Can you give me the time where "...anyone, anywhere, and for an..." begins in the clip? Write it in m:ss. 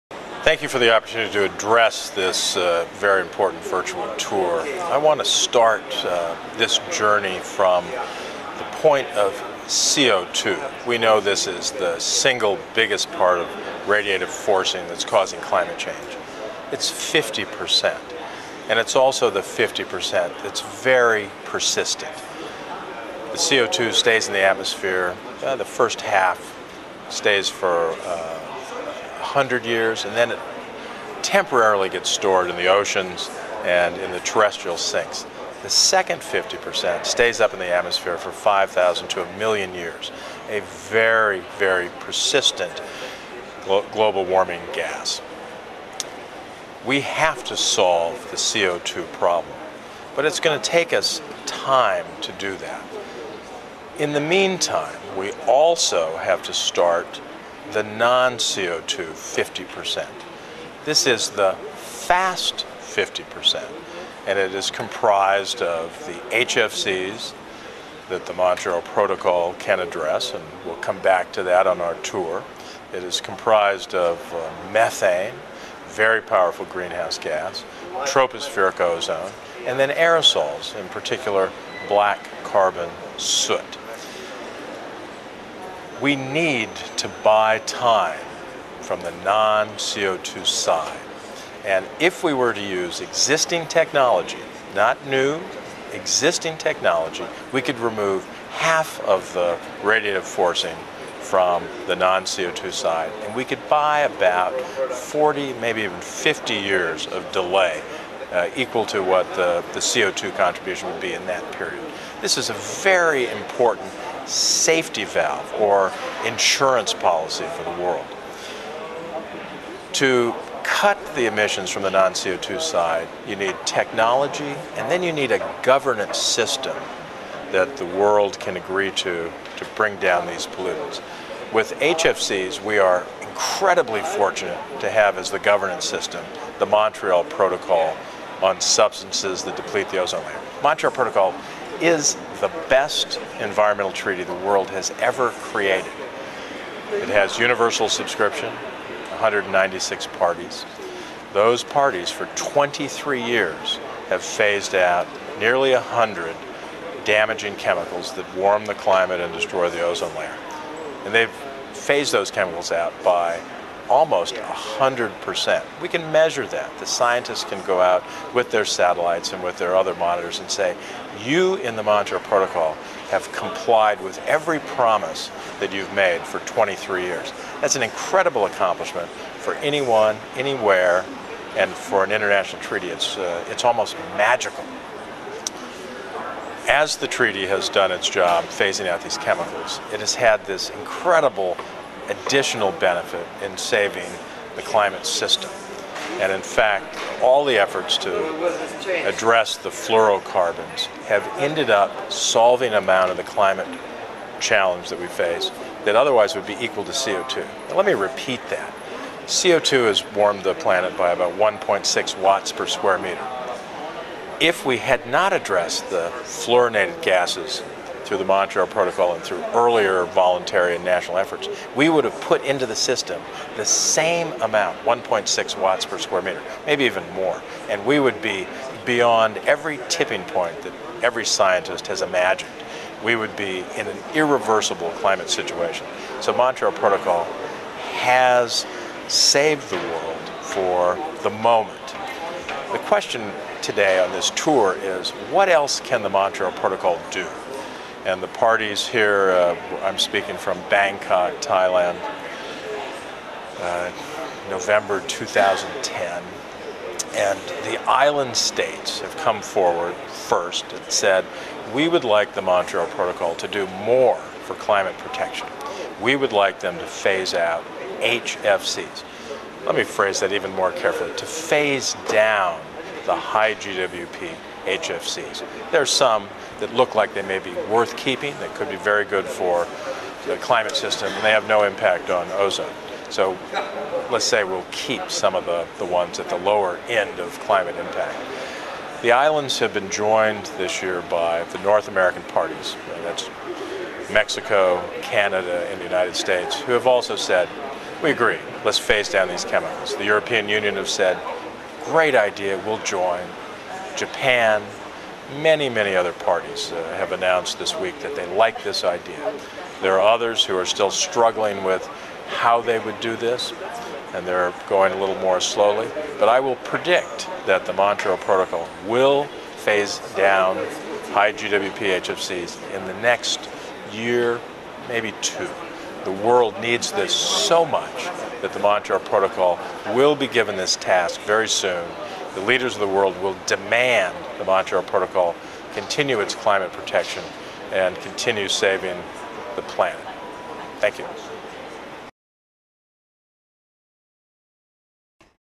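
2:59.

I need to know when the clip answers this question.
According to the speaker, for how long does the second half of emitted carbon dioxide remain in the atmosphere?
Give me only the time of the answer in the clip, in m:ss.
0:38.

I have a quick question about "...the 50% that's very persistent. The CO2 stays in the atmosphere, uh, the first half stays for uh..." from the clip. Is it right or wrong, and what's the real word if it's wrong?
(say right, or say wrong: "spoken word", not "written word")
right.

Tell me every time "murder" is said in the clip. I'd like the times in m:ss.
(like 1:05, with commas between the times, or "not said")
not said.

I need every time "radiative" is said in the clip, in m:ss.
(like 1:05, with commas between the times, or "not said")
0:13, 1:39.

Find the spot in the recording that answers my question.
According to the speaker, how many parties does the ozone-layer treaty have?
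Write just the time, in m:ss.
2:29.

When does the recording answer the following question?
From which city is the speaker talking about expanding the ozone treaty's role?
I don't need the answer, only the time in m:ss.
4:10.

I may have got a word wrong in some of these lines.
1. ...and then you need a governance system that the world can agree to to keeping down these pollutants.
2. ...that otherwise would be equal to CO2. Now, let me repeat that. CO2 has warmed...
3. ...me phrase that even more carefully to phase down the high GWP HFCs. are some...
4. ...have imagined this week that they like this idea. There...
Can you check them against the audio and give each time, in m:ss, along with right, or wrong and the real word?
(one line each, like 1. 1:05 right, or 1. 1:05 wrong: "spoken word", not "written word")
1. 2:04 wrong: "bring", not "keeping"
2. 3:25 right
3. 4:29 right
4. 5:06 wrong: "announced", not "imagined".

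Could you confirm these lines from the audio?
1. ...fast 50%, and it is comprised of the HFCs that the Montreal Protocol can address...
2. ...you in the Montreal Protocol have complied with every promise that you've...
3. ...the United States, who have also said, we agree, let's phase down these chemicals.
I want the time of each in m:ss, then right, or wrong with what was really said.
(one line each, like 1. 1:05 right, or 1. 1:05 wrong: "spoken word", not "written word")
1. 1:01 right
2. 2:51 right
3. 4:55 right.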